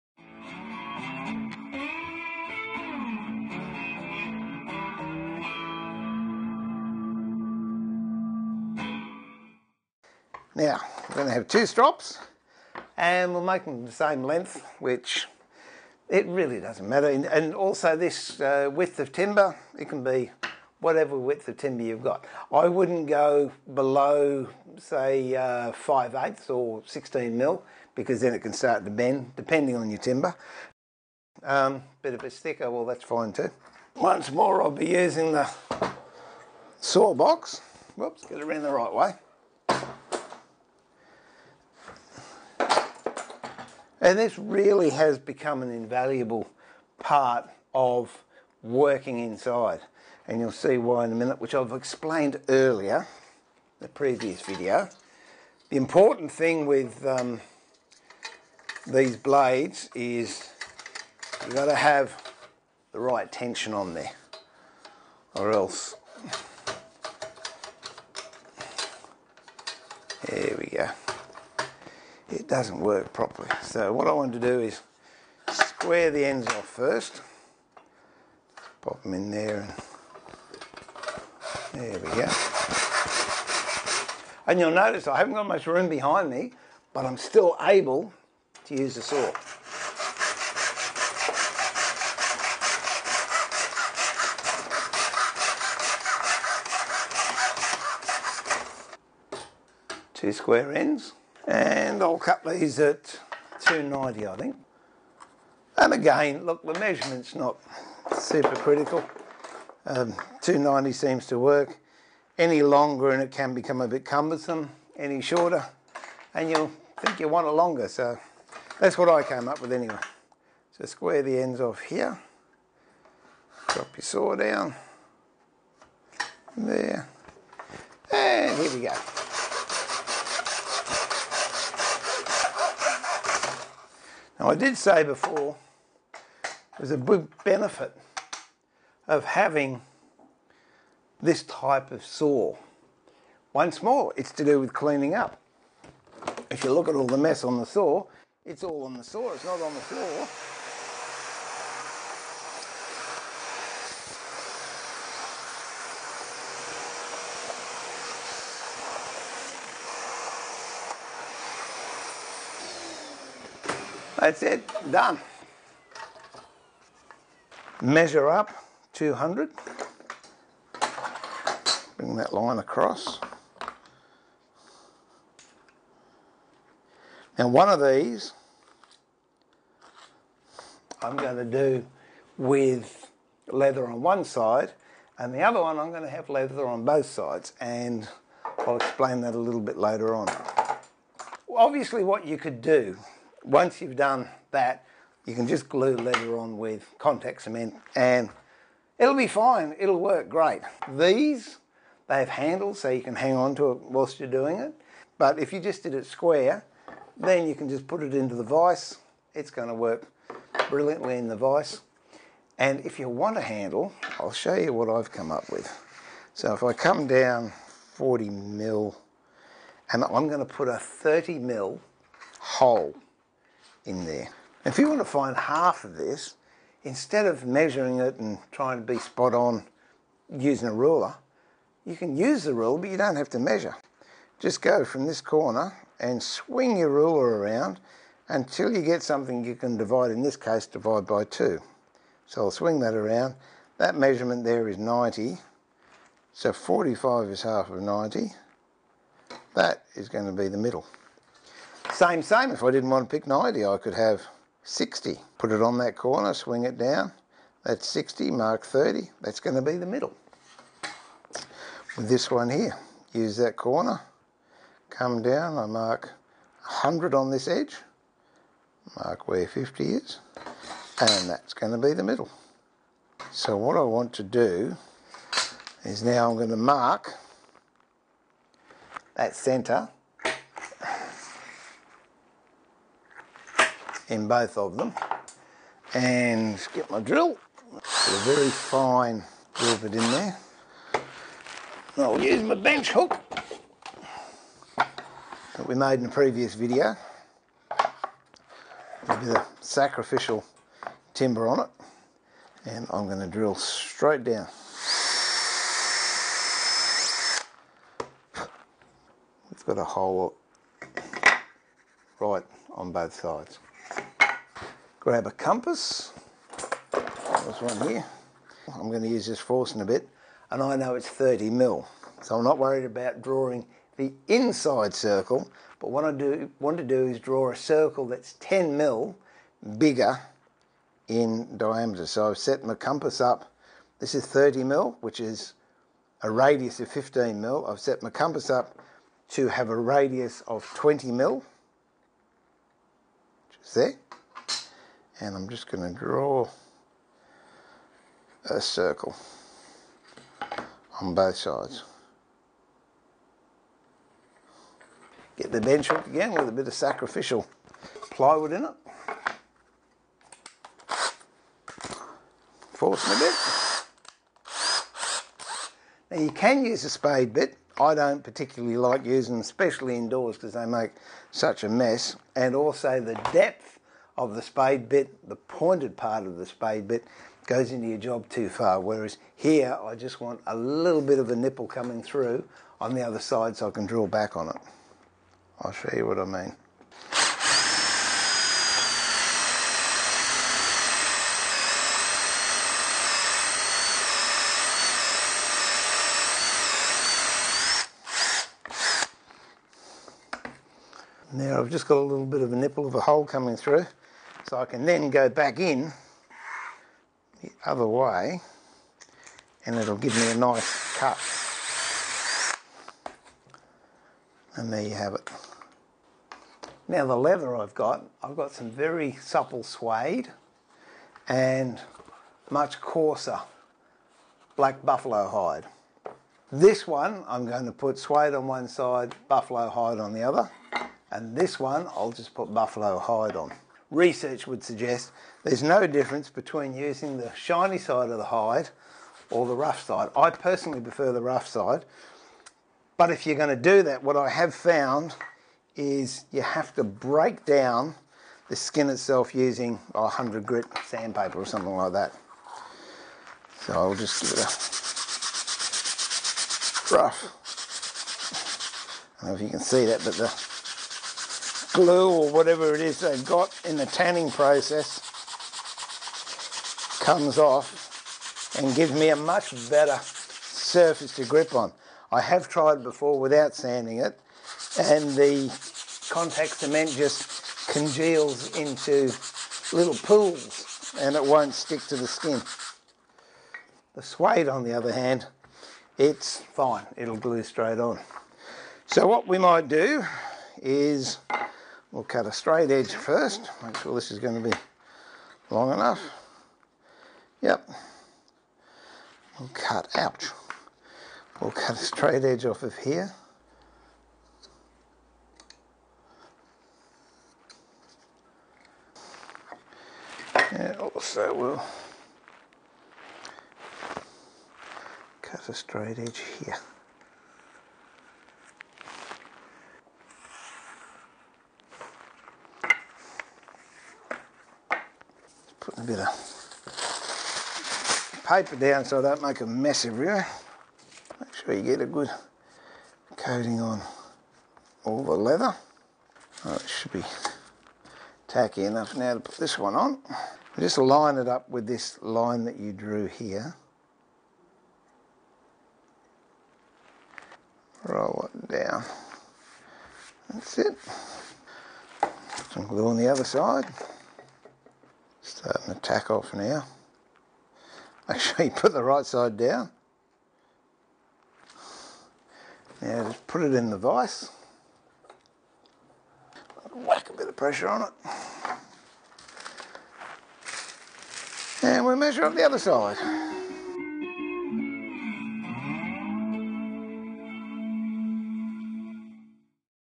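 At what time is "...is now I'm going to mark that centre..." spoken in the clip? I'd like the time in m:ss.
4:35.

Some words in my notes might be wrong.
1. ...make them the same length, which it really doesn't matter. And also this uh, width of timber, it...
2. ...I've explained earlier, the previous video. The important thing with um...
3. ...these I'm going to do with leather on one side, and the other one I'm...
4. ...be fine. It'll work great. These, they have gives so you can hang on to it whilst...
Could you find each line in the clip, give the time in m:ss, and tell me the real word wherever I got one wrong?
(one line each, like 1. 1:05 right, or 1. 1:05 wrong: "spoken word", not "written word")
1. 0:13 right
2. 0:51 right
3. 2:57 right
4. 3:19 wrong: "handles", not "gives".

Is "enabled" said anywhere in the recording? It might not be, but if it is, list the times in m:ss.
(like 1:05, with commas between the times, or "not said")
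not said.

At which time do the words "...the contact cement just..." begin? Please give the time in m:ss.
7:55.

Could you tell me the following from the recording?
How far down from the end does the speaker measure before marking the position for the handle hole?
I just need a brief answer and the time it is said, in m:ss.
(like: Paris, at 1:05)
40 mm, at 3:37.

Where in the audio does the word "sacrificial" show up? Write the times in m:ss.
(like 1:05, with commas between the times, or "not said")
4:59, 5:56.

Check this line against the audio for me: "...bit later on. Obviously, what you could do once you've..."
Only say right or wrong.
right.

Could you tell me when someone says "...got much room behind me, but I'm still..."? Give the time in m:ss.
1:25.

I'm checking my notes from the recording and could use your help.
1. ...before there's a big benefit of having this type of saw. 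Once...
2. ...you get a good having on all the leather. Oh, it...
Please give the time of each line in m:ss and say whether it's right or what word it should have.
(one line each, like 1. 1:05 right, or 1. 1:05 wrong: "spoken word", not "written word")
1. 2:15 right
2. 8:51 wrong: "coating", not "having".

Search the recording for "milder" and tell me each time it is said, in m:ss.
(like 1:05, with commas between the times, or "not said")
not said.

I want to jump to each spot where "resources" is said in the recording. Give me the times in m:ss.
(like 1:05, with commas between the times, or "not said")
not said.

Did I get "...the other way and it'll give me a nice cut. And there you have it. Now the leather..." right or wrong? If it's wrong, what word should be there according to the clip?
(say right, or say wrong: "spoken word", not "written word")
right.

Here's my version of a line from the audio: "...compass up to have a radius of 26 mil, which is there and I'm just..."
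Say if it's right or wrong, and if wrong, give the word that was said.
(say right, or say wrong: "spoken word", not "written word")
wrong: "20", not "26".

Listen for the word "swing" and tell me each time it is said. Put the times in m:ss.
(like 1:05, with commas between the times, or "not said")
3:56, 4:02, 4:16.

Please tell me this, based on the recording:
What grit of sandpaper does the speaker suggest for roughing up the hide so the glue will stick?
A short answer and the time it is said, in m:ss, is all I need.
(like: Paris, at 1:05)
100, at 7:30.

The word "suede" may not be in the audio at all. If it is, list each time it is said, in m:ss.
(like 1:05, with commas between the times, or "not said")
6:59, 7:07, 8:04.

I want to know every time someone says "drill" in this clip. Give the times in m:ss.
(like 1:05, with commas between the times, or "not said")
4:46, 5:03, 6:23.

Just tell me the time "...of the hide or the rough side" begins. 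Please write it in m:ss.
7:18.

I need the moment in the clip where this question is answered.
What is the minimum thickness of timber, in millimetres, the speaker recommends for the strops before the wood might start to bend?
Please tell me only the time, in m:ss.
0:26.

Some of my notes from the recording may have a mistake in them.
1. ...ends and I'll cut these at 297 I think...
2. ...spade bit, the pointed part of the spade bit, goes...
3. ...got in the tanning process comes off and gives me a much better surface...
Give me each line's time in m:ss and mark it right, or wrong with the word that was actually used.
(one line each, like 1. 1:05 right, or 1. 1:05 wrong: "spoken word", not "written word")
1. 1:40 wrong: "290", not "297"
2. 6:14 right
3. 7:43 right.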